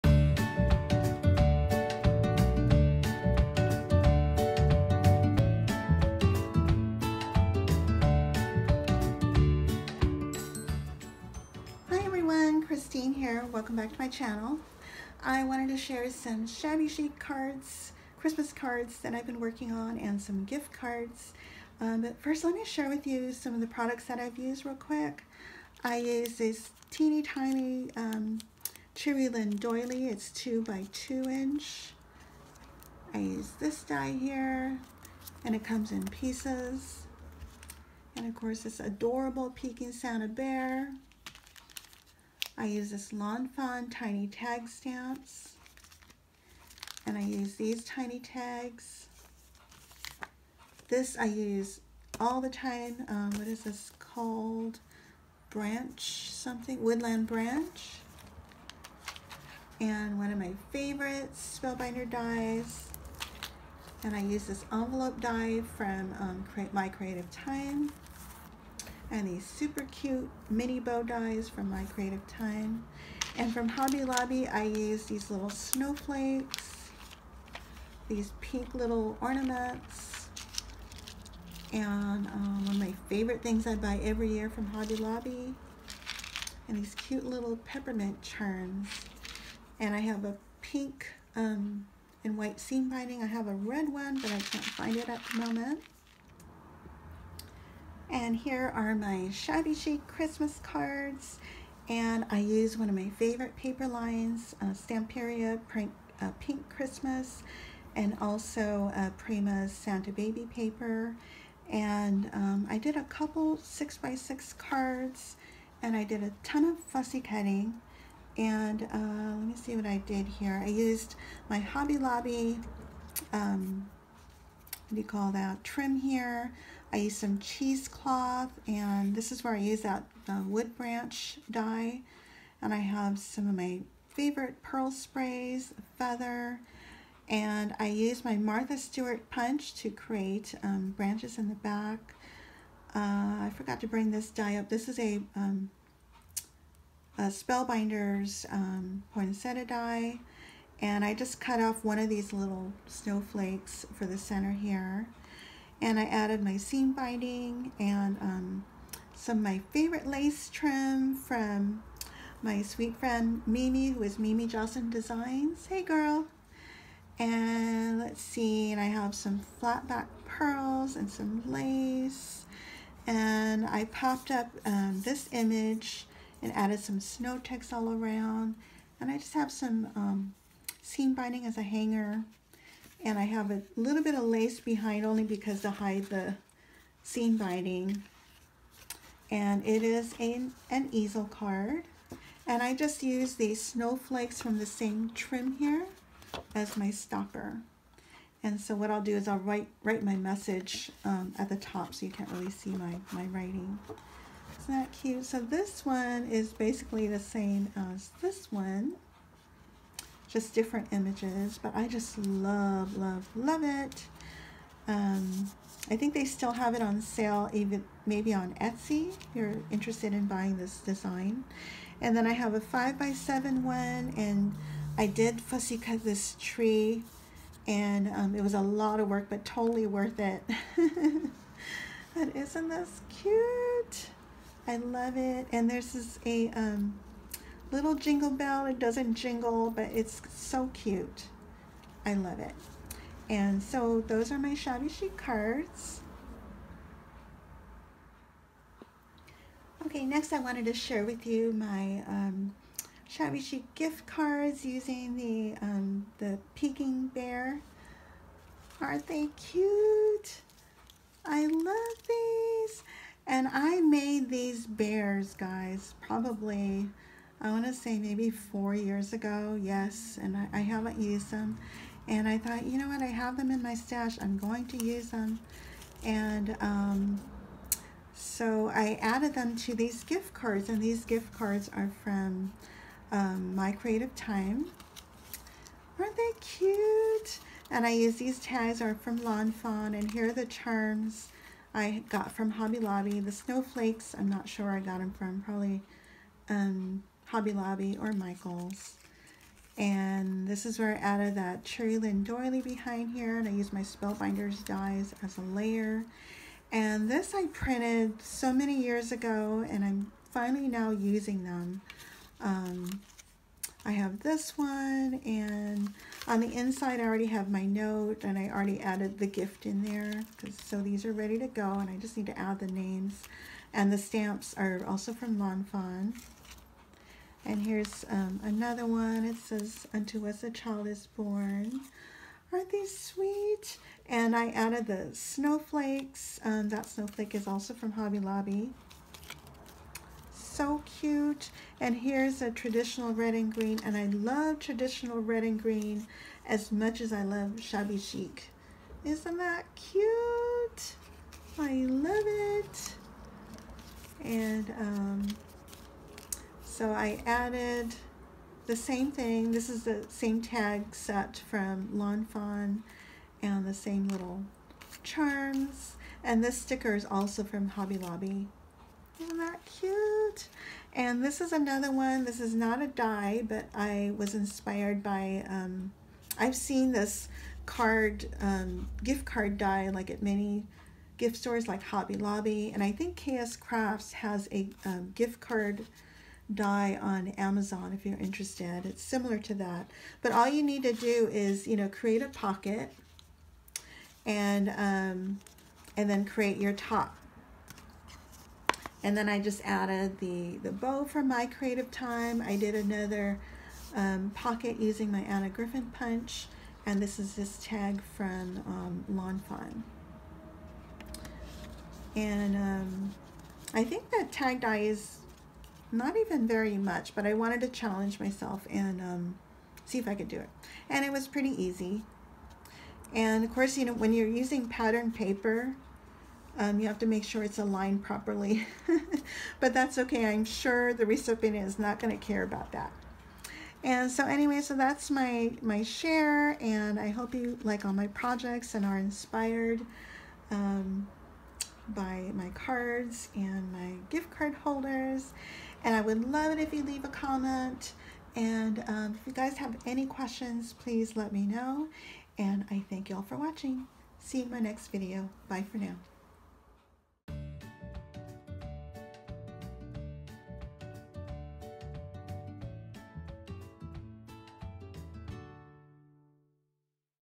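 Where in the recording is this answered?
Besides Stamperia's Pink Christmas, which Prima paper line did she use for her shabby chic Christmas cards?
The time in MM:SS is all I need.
01:49.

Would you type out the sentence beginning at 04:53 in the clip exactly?
The snowflakes, I'm not sure I got them from, probably um, Hobby Lobby or Michael's.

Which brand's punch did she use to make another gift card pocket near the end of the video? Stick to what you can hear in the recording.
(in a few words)
Anna Griffin.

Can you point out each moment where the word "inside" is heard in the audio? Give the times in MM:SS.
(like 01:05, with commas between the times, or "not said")
05:16.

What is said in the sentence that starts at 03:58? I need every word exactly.
It doesn't jingle, but it's so cute.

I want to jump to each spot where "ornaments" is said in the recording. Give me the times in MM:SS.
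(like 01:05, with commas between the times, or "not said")
01:19.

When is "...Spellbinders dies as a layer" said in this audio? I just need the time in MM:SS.
05:03.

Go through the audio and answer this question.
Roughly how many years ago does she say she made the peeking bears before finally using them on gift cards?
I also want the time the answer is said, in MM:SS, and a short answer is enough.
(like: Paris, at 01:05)
4, at 04:28.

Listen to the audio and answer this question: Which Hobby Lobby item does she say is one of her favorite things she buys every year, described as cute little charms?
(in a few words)
peppermint charms.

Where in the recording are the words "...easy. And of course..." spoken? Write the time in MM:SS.
07:01.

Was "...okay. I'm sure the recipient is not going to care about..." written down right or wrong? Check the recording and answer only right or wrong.
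right.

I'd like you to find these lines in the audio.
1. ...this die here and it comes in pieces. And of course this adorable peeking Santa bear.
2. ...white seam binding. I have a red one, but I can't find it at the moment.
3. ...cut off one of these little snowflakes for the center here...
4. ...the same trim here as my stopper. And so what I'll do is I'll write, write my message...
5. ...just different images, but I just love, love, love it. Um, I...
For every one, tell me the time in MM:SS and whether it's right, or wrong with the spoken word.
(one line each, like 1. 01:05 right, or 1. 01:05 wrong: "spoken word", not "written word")
1. 00:33 right
2. 01:32 right
3. 02:31 right
4. 03:14 right
5. 03:30 right.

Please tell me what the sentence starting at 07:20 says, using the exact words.
Um, by my cards and my gift card holders.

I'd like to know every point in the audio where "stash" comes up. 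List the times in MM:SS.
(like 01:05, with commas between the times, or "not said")
04:33.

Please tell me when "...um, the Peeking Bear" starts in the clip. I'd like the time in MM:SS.
04:15.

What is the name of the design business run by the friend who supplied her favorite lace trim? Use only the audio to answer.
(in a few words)
Mimi Jocelyn Designs.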